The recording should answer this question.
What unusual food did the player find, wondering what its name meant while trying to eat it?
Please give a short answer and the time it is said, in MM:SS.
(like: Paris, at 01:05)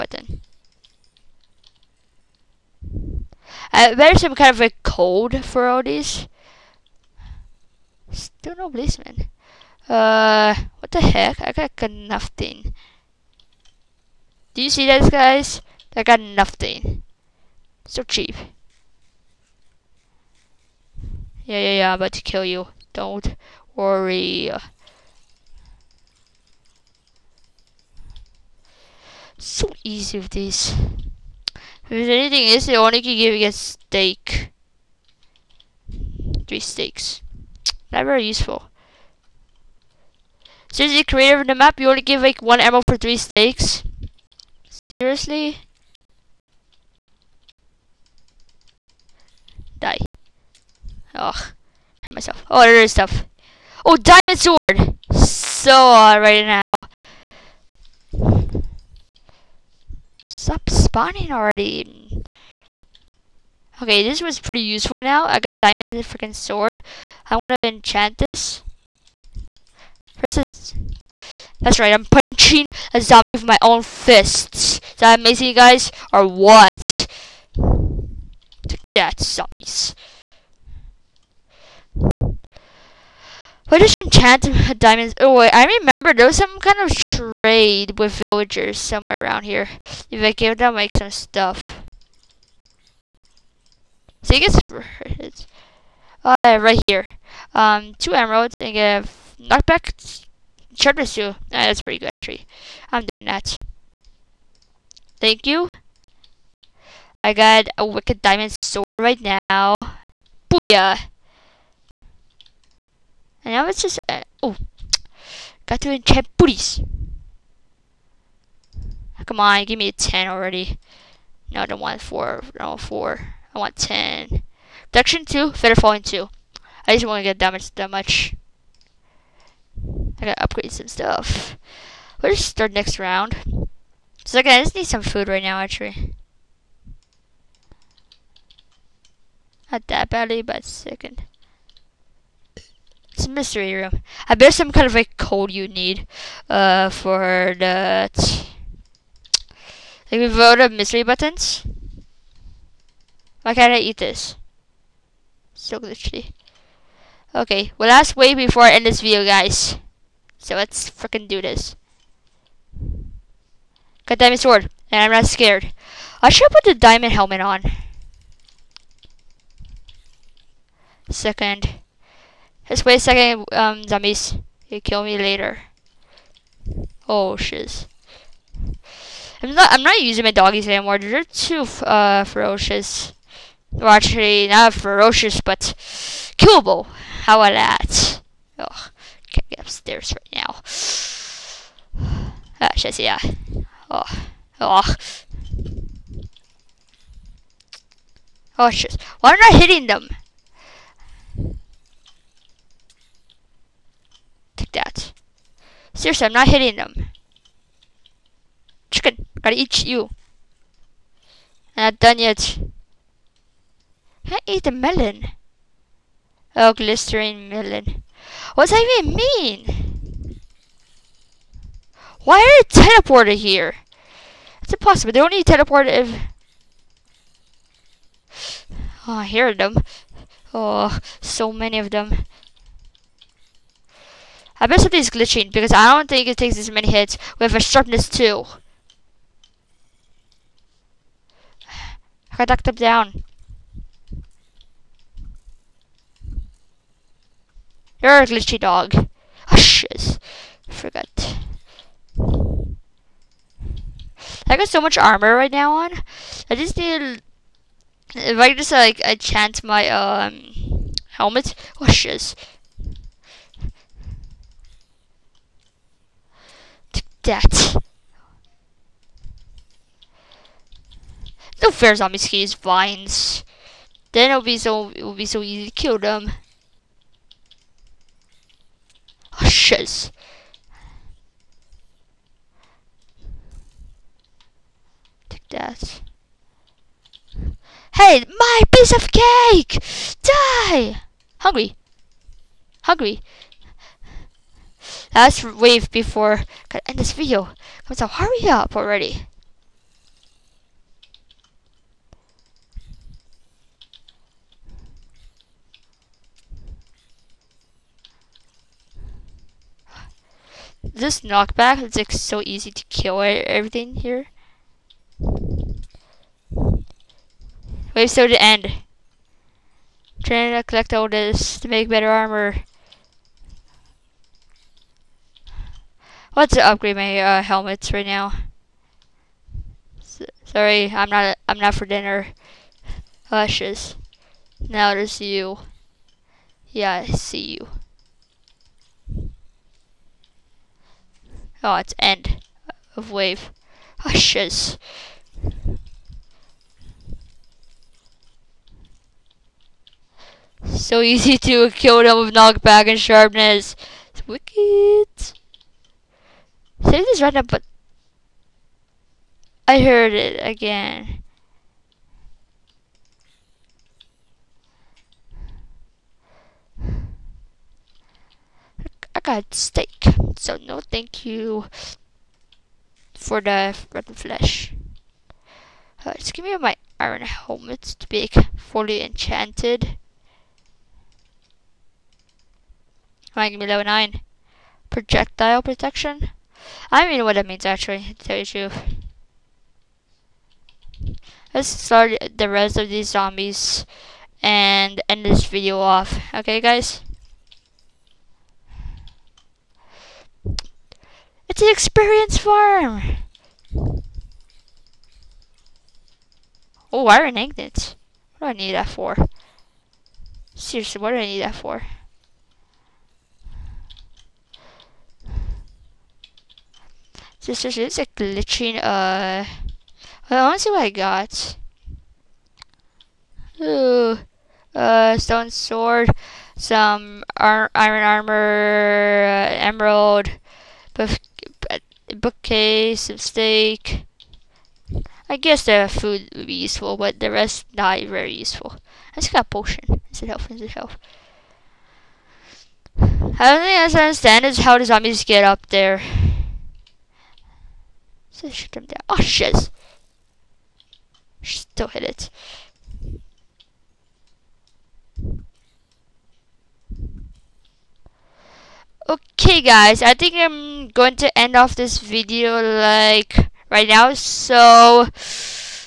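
Glistering melon, at 03:36.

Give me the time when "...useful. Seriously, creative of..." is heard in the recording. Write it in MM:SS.
00:38.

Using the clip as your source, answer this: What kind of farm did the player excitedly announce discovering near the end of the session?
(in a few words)
Experience farm.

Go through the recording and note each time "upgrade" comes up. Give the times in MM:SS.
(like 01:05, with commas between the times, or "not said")
02:10, 05:26.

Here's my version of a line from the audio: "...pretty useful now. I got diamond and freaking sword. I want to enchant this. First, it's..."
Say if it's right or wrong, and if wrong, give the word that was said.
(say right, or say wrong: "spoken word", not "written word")
right.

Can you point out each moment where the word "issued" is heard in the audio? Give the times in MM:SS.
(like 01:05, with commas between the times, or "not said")
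not said.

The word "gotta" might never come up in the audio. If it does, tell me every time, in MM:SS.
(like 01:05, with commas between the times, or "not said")
02:10, 03:29.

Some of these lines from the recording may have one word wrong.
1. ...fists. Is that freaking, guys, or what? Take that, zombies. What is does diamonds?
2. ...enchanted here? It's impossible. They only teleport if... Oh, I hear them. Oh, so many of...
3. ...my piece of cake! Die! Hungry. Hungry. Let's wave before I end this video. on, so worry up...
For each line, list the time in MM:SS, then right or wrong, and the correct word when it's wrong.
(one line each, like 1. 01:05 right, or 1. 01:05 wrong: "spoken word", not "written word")
1. 01:13 wrong: "amazing", not "freaking"
2. 03:42 wrong: "teleported", not "enchanted"
3. 04:48 wrong: "hurry", not "worry".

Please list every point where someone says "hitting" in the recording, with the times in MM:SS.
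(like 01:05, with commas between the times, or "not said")
03:19, 03:26.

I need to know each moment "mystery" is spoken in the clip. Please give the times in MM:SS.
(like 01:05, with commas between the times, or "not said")
02:23, 02:30.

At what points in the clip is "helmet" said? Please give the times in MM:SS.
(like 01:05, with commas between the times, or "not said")
02:47, 04:21, 05:27, 06:17.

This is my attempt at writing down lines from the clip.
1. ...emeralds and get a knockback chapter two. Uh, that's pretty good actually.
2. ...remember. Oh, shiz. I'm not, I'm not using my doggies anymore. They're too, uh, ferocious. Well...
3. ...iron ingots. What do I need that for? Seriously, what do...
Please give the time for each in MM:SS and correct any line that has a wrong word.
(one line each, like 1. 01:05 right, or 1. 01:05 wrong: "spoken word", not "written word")
1. 01:38 right
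2. 02:55 wrong: "later", not "remember"
3. 06:47 right.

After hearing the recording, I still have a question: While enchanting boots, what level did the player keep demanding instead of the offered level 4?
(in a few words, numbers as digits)
10.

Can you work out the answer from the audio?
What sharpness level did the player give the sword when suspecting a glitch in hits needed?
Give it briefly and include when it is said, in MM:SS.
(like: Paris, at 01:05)
Sharpness 2, at 03:57.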